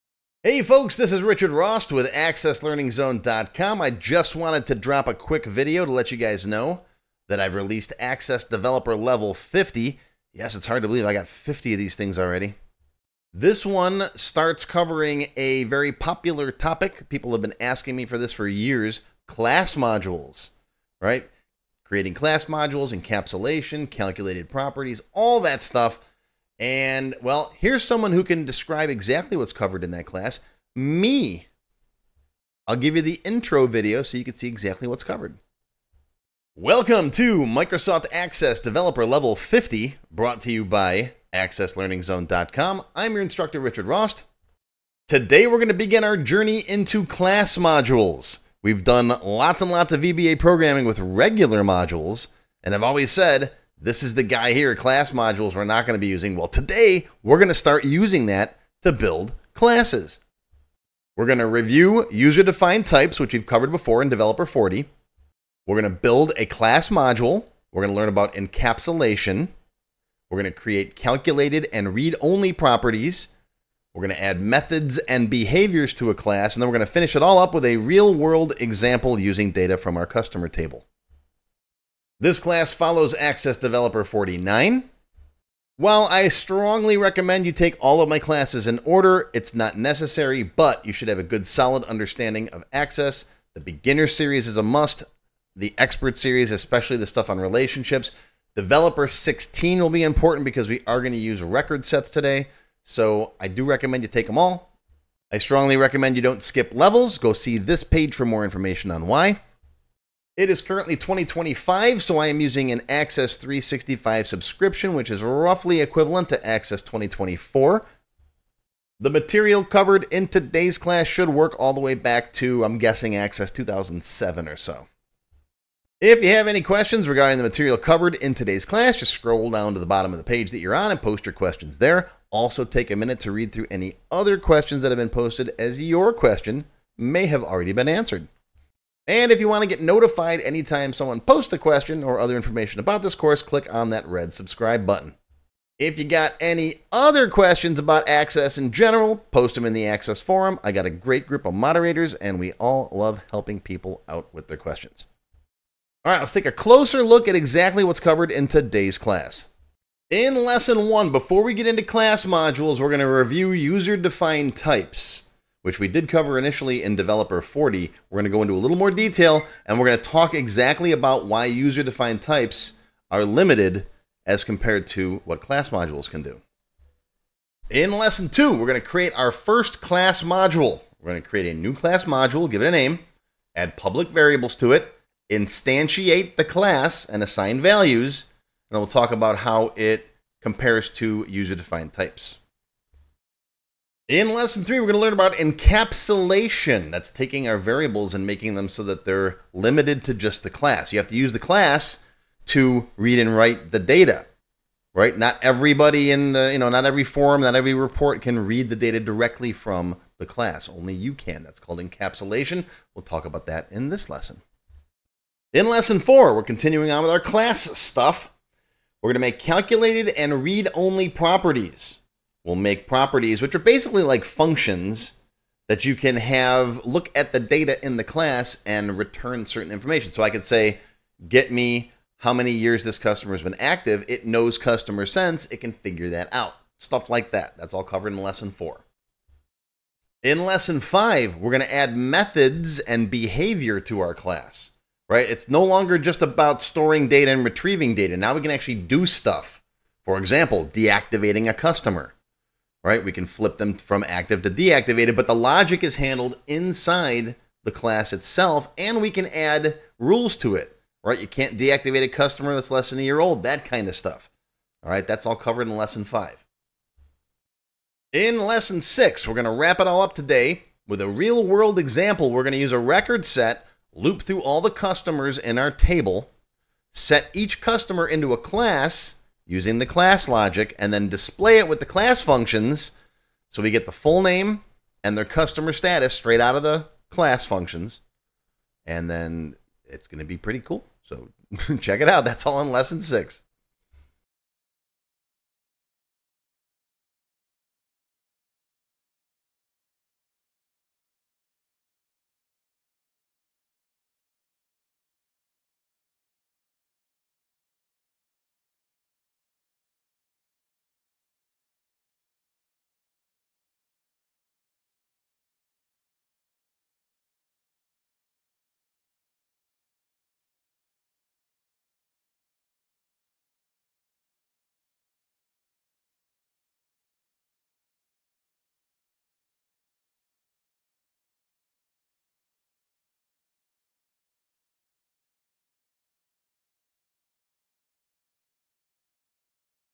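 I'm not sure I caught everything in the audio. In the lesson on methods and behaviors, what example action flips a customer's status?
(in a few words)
Deactivating a customer.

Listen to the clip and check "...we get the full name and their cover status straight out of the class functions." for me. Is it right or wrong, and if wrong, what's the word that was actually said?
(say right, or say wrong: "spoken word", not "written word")
wrong: "customer", not "cover".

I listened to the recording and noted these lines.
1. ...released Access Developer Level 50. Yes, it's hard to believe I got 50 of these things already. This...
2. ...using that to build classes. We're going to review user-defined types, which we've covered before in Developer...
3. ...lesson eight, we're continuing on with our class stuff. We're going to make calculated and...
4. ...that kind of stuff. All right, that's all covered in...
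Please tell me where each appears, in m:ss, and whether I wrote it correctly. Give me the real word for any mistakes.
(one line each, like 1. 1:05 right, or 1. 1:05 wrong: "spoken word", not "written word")
1. 0:07 right
2. 0:57 right
3. 3:35 wrong: "four", not "eight"
4. 4:23 right.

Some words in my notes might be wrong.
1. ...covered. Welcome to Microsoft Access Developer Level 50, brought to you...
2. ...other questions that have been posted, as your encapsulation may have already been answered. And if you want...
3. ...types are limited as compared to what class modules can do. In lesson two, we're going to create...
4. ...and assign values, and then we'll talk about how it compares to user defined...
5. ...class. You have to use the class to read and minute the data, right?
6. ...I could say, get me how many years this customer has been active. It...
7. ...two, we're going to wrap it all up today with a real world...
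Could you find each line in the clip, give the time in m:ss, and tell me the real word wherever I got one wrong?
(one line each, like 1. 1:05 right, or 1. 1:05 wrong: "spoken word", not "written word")
1. 0:35 right
2. 2:14 wrong: "question", not "encapsulation"
3. 2:52 right
4. 3:07 right
5. 3:20 wrong: "write", not "minute"
6. 3:50 right
7. 4:28 wrong: "six", not "two".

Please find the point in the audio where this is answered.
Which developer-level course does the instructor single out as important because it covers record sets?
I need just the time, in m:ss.
1:38.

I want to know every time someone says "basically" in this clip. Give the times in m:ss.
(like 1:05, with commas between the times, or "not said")
3:43.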